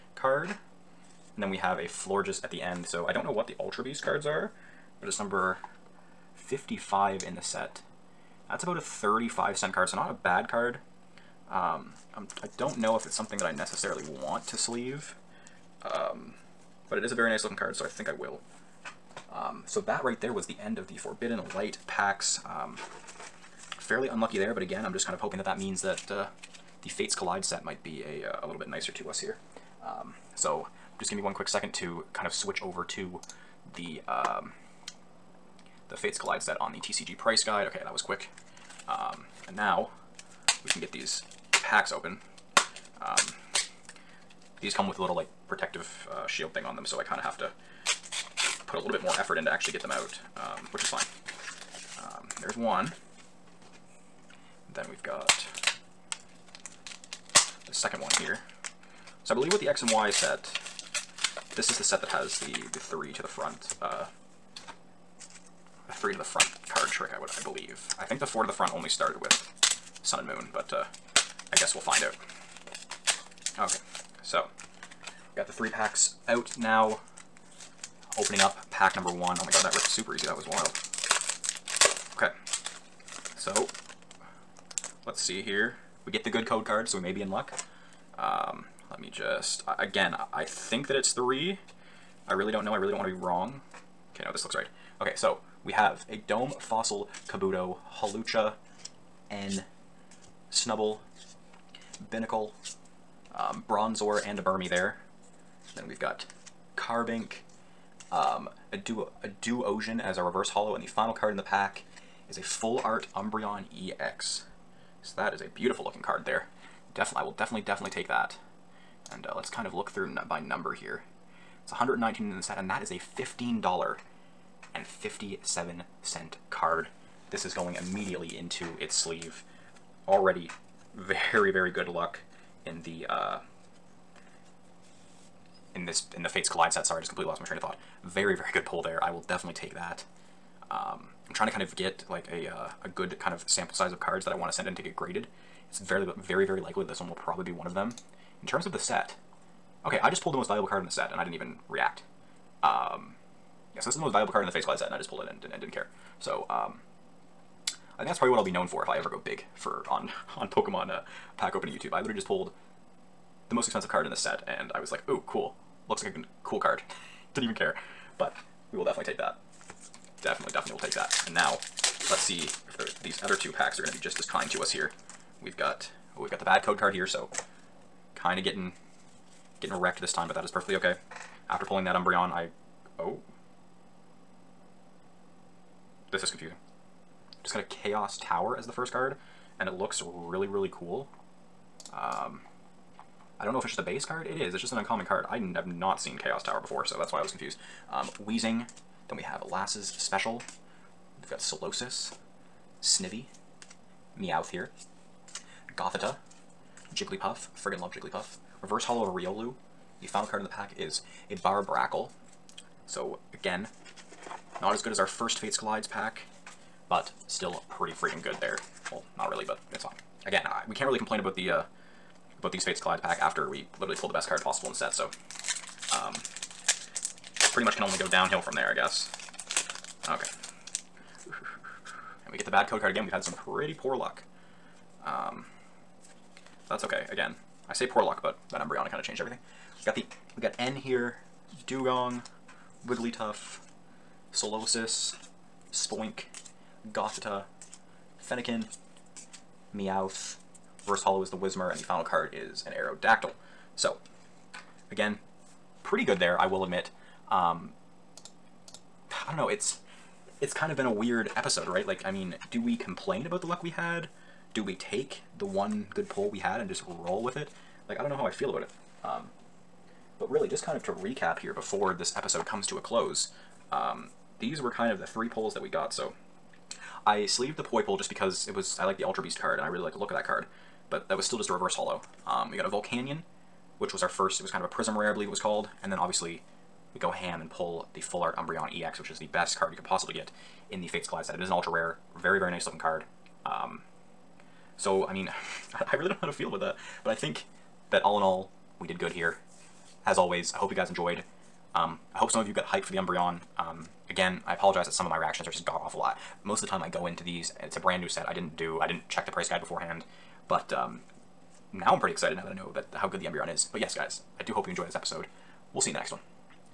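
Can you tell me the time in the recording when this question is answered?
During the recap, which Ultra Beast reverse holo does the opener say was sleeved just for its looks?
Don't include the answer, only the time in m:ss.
4:37.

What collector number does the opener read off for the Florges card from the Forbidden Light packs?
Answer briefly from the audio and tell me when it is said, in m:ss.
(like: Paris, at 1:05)
55, at 0:05.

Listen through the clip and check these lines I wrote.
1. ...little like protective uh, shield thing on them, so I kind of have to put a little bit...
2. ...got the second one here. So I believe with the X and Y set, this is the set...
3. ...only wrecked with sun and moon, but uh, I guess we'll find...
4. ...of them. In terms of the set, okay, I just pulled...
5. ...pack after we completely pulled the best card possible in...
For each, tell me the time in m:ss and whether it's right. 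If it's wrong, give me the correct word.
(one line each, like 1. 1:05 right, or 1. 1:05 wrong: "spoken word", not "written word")
1. 0:45 right
2. 0:55 right
3. 1:08 wrong: "started", not "wrecked"
4. 2:27 right
5. 3:43 wrong: "literally", not "completely".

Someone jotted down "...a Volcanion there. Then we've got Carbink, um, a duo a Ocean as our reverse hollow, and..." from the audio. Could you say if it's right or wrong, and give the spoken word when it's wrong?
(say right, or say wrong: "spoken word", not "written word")
wrong: "Burmy", not "Volcanion".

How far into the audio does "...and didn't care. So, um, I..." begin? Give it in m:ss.
2:35.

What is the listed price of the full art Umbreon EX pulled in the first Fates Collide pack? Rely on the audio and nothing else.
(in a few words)
$15.57.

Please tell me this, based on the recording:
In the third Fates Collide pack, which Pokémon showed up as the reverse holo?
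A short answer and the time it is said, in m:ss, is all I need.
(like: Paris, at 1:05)
Whismur, at 4:11.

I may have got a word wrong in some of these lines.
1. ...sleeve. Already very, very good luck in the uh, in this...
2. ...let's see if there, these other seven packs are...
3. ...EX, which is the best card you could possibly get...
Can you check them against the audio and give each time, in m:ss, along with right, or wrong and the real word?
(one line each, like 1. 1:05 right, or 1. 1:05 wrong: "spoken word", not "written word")
1. 2:08 right
2. 2:52 wrong: "two", not "seven"
3. 4:48 right.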